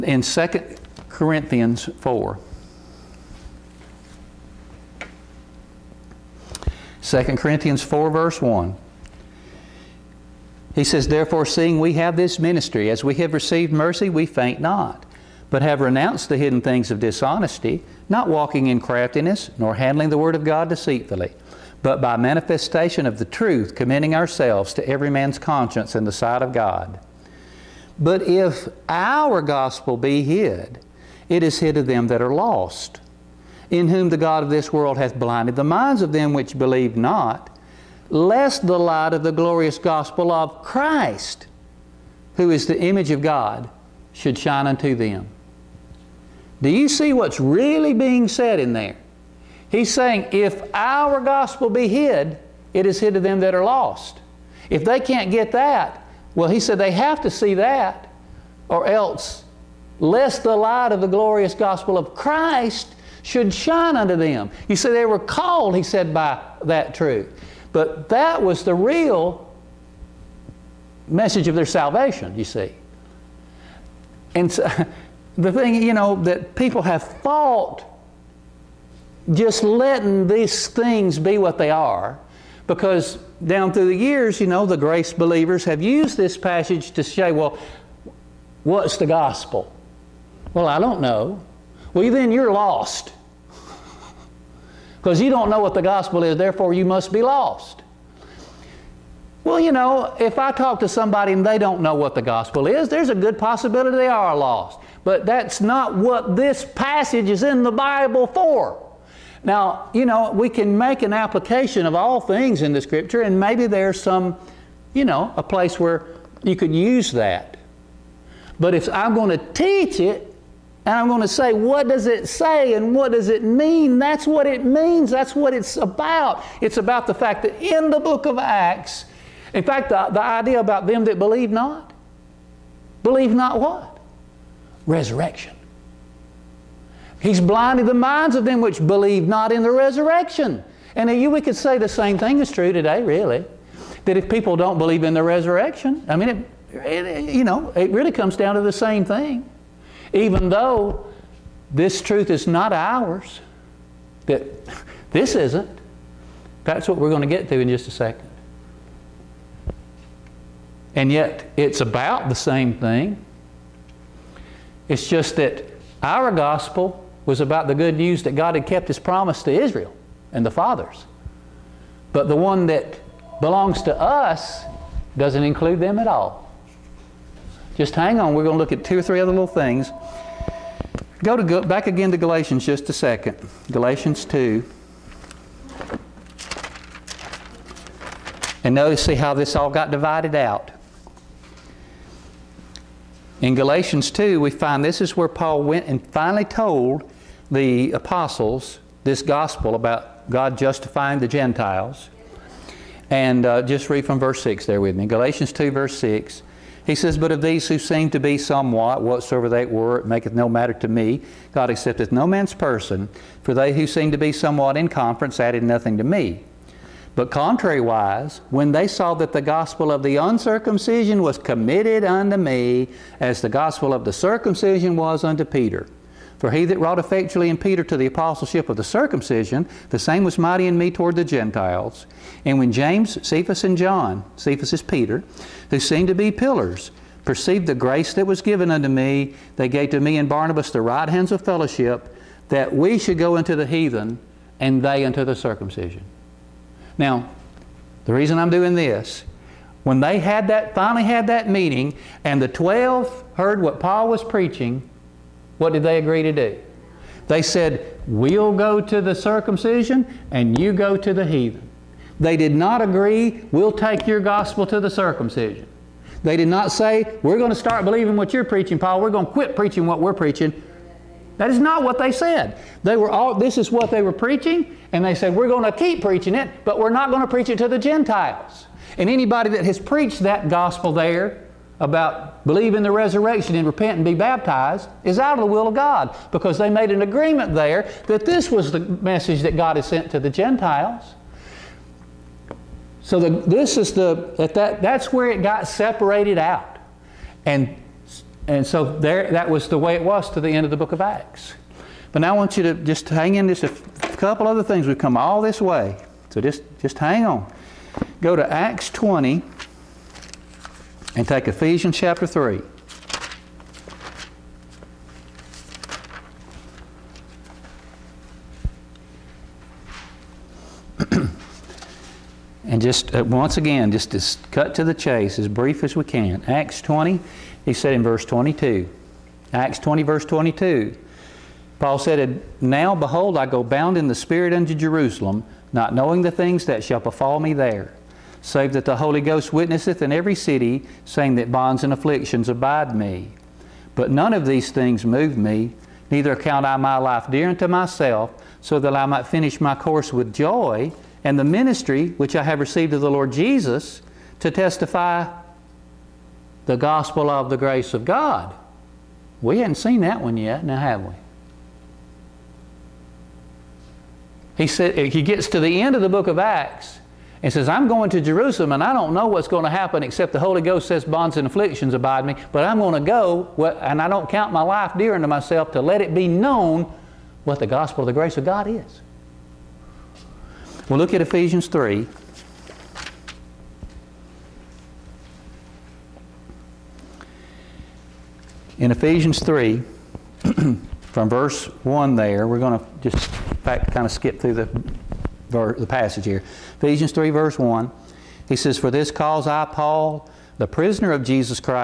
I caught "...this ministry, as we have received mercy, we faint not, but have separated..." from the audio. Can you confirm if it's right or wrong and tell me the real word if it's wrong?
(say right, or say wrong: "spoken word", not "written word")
wrong: "renounced", not "separated".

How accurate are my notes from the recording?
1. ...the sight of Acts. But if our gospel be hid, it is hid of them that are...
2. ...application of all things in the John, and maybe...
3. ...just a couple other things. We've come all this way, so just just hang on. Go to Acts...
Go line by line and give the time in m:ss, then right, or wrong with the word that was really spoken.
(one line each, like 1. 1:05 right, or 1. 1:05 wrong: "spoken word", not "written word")
1. 0:26 wrong: "God", not "Acts"
2. 1:51 wrong: "Scripture", not "John"
3. 5:03 right.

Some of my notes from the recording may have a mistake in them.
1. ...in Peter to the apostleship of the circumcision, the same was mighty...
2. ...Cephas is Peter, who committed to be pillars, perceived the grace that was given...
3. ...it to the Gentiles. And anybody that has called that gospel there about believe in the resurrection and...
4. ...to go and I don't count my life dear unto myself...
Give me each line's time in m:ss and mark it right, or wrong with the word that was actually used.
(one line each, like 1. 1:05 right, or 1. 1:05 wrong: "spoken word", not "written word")
1. 3:47 right
2. 3:54 wrong: "seemed", not "committed"
3. 4:37 wrong: "preached", not "called"
4. 6:13 right.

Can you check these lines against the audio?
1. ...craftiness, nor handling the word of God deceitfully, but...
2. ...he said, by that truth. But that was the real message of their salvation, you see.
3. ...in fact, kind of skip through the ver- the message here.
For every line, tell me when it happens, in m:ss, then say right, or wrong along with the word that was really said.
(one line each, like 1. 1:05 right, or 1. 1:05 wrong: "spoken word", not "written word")
1. 0:18 right
2. 1:05 right
3. 6:33 wrong: "passage", not "message".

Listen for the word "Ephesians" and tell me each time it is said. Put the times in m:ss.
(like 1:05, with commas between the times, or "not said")
5:11, 6:21, 6:28, 6:36.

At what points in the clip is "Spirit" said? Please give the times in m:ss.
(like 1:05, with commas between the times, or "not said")
5:34.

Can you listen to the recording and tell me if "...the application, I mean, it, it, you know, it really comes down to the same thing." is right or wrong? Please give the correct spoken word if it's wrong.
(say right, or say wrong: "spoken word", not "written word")
wrong: "resurrection", not "application".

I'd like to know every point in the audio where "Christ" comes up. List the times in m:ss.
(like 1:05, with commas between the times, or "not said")
0:40, 1:02.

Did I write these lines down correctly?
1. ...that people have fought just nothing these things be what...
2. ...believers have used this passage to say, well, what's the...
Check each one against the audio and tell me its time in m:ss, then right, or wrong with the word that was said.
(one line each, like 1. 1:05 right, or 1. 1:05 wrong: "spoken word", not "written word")
1. 1:16 wrong: "letting", not "nothing"
2. 1:25 right.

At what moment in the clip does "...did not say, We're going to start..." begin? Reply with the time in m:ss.
4:26.